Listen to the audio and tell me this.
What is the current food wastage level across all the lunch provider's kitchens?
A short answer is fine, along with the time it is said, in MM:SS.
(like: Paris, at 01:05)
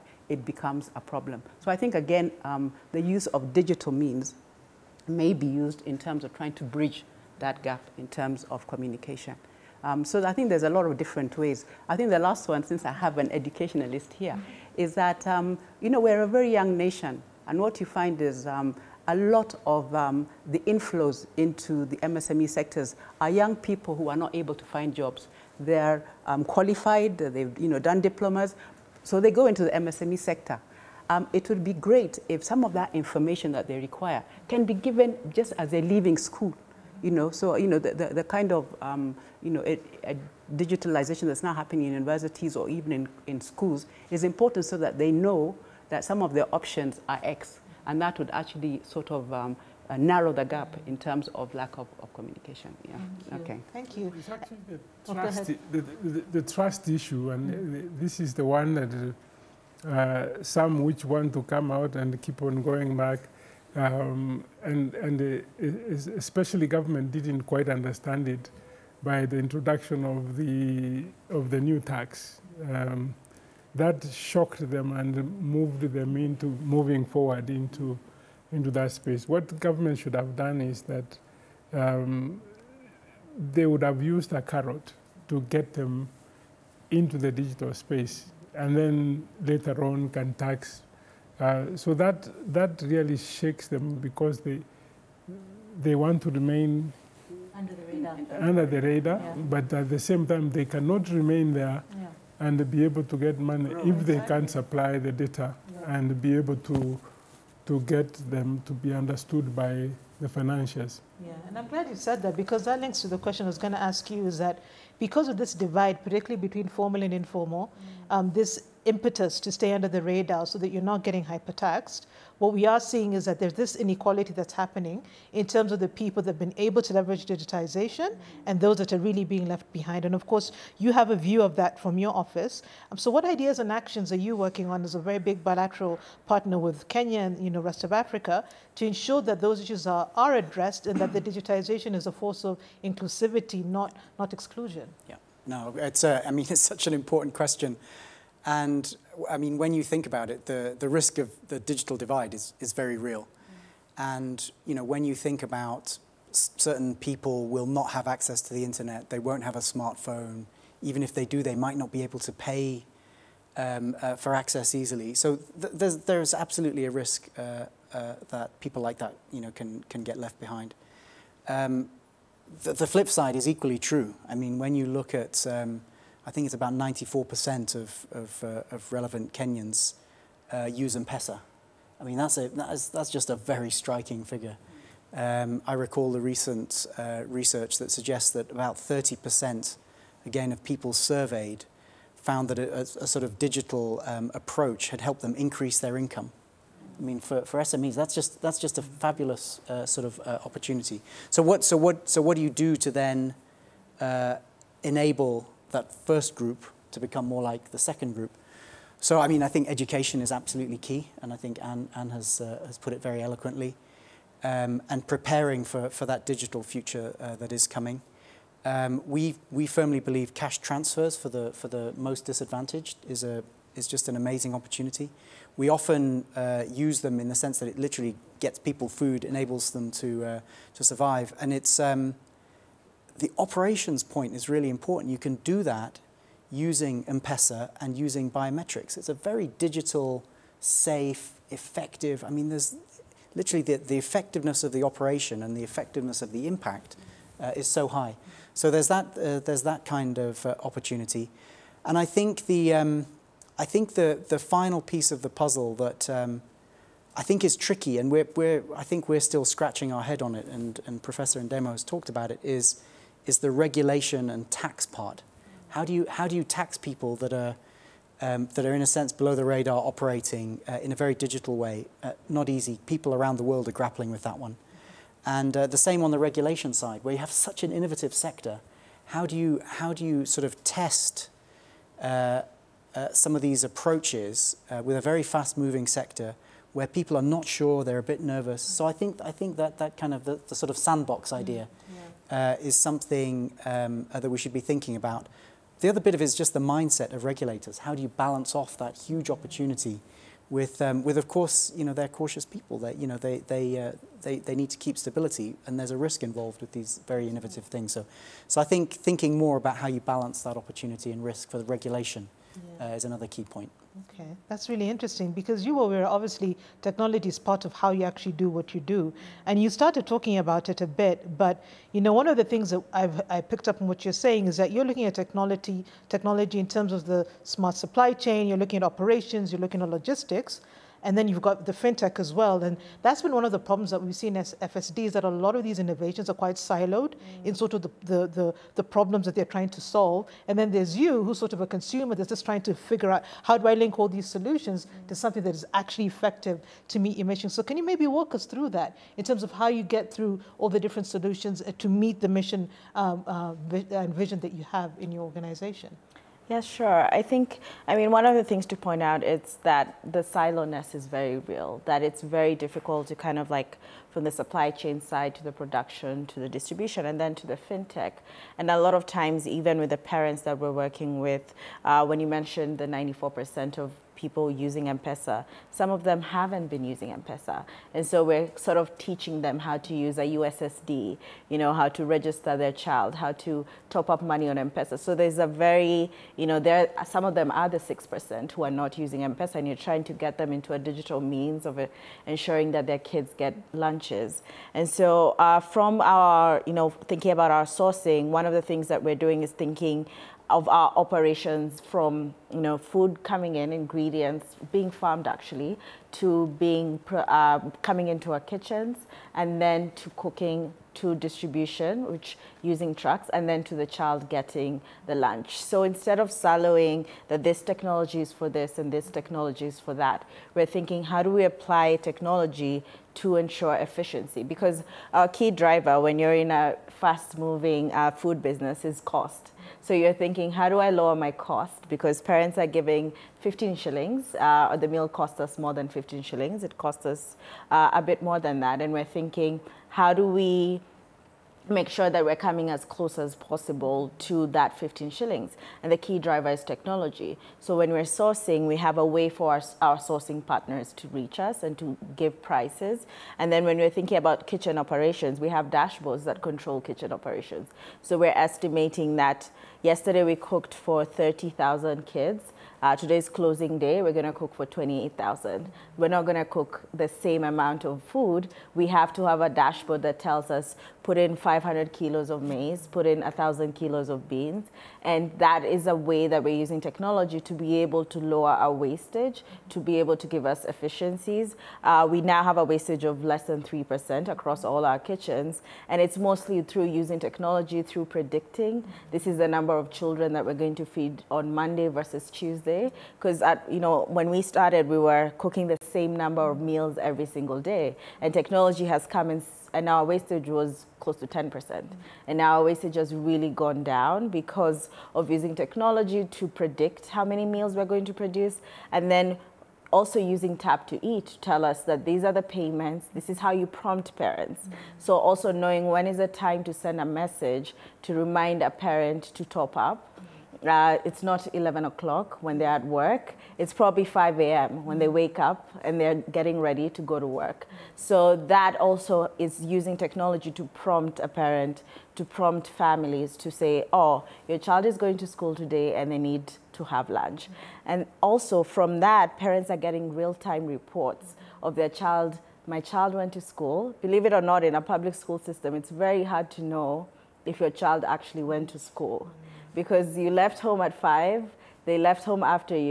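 less than 3%, at 08:03.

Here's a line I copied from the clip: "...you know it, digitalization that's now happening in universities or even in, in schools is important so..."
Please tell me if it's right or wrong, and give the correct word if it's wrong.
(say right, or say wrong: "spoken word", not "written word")
right.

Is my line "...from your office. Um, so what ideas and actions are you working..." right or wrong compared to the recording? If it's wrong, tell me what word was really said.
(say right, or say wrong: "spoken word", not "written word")
right.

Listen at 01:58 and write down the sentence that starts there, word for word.
um, this impetus to stay under the radar so that you're not getting hypertaxed.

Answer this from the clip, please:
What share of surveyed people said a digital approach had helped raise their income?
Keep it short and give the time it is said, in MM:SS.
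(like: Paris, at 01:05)
30%, at 03:08.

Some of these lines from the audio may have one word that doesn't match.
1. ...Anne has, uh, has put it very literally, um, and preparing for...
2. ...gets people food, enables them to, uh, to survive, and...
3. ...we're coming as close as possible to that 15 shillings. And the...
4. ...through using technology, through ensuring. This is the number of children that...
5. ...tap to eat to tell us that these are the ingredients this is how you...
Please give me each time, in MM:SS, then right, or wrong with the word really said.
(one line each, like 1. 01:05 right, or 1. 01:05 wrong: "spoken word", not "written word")
1. 03:31 wrong: "eloquently", not "literally"
2. 03:48 right
3. 07:22 right
4. 08:06 wrong: "predicting", not "ensuring"
5. 08:30 wrong: "payments", not "ingredients".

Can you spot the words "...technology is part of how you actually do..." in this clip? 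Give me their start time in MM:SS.
05:16.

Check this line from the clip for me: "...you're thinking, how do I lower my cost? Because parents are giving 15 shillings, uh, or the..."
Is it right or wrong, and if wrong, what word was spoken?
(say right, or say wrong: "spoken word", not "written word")
right.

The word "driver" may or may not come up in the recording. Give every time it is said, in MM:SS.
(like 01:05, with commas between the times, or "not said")
07:05, 07:26.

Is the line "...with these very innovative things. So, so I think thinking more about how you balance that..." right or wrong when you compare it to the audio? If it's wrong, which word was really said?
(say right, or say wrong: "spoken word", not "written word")
right.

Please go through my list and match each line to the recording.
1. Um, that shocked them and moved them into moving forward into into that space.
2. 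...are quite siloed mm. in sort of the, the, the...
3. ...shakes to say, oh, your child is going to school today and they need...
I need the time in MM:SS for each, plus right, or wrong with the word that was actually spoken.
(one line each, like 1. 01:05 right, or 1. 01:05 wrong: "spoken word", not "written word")
1. 01:12 right
2. 05:36 right
3. 08:52 wrong: "families", not "shakes".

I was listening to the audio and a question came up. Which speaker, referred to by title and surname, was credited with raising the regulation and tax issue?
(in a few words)
Professor Ndemo.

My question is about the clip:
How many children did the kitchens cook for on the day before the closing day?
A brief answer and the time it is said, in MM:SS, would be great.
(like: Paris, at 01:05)
30,000, at 07:41.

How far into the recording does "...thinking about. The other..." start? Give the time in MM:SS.
04:54.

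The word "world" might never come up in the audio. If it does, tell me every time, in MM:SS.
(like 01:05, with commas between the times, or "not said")
04:33.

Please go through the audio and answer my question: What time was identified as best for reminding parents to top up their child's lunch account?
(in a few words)
5 a.m.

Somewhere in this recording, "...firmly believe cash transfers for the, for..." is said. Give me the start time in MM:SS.
03:39.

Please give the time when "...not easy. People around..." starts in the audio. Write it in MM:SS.
04:32.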